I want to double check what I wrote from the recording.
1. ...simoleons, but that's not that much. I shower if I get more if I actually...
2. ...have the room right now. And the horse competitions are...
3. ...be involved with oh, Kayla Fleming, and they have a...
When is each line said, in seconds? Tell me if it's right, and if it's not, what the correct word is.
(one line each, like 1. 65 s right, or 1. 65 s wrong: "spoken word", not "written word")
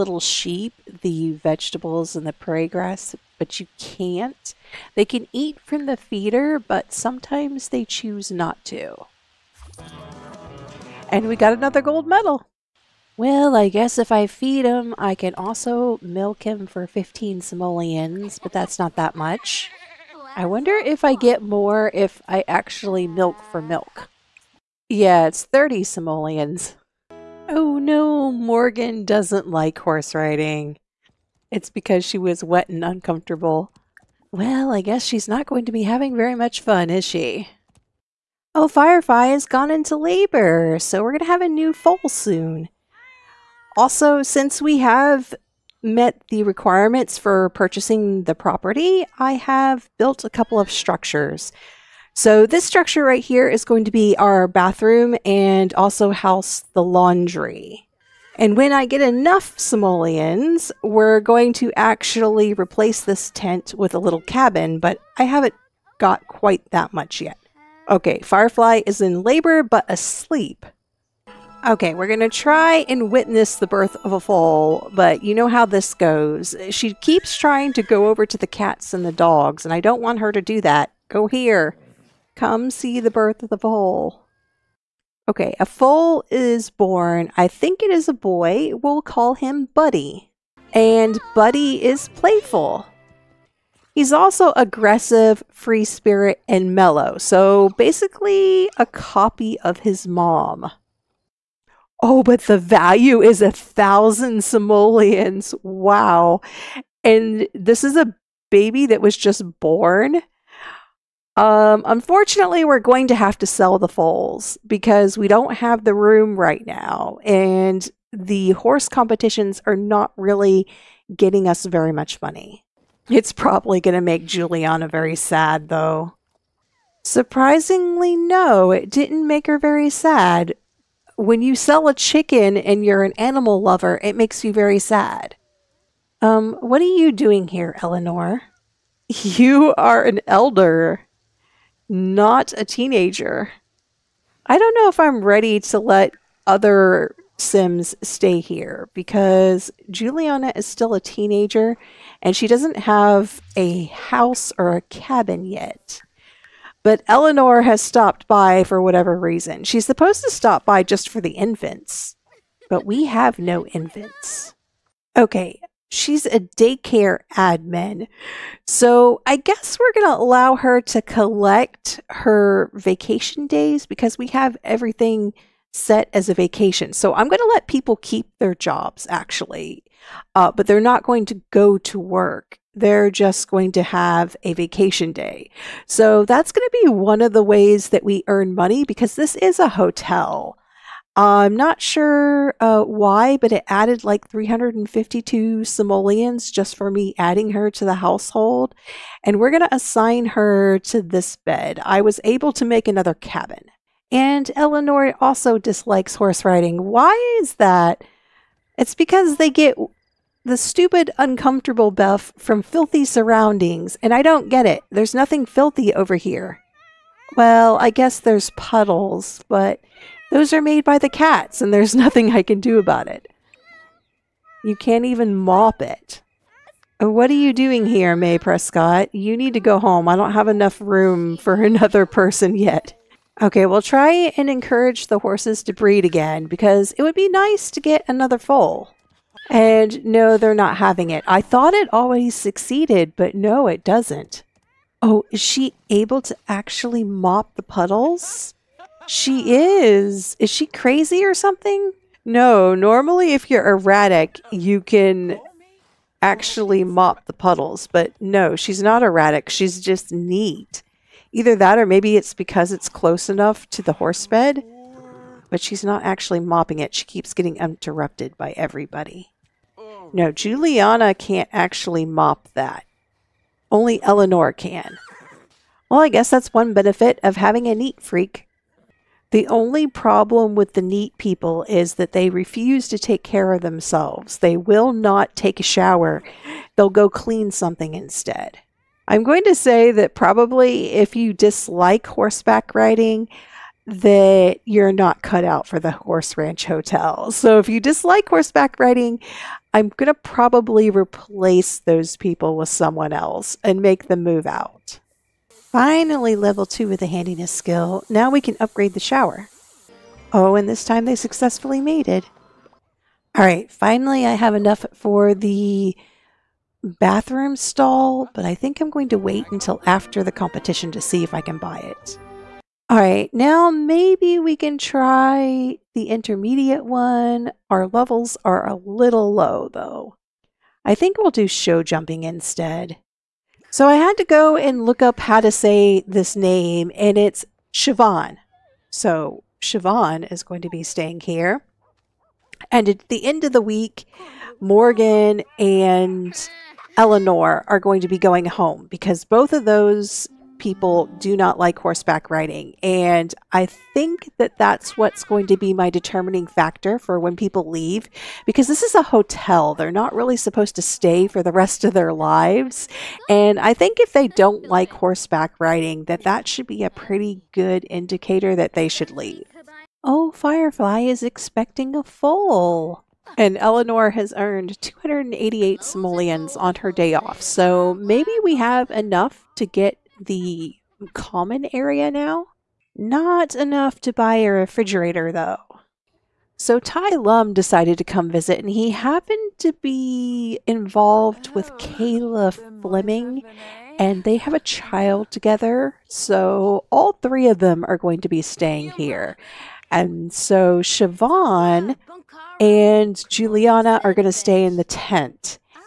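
1. 17 s wrong: "wonder", not "shower"
2. 115 s right
3. 389 s right.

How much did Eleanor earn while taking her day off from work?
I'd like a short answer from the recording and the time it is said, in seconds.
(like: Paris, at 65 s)
288 simoleons, at 374 s.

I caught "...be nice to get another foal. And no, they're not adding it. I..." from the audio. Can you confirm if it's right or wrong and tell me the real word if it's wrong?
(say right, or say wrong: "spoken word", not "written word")
wrong: "having", not "adding".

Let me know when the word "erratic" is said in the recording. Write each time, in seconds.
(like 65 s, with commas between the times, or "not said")
253 s, 259 s.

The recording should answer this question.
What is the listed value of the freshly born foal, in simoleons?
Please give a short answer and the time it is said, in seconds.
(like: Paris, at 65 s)
1000, at 103 s.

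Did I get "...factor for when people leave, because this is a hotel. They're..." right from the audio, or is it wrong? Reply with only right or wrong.
right.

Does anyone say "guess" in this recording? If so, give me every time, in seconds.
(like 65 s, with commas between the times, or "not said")
13 s, 34 s, 169 s, 217 s, 276 s.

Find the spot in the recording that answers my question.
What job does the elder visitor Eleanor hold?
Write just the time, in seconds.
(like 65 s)
166 s.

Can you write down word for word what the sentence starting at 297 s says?
So if you dislike horseback riding, I'm going to probably replace those people with someone else and make them move out.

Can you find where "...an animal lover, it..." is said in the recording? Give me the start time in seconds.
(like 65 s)
133 s.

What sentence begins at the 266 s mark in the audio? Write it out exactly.
She keeps getting interrupted by everybody.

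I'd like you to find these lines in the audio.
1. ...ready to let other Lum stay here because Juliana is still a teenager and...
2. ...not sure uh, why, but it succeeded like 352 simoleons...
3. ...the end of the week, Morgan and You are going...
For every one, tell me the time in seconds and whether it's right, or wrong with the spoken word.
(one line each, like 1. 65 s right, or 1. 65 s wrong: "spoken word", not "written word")
1. 145 s wrong: "Sims", not "Lum"
2. 191 s wrong: "added", not "succeeded"
3. 343 s wrong: "Eleanor", not "You".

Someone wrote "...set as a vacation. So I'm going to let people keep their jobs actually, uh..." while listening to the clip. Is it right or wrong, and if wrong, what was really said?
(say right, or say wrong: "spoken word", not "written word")
right.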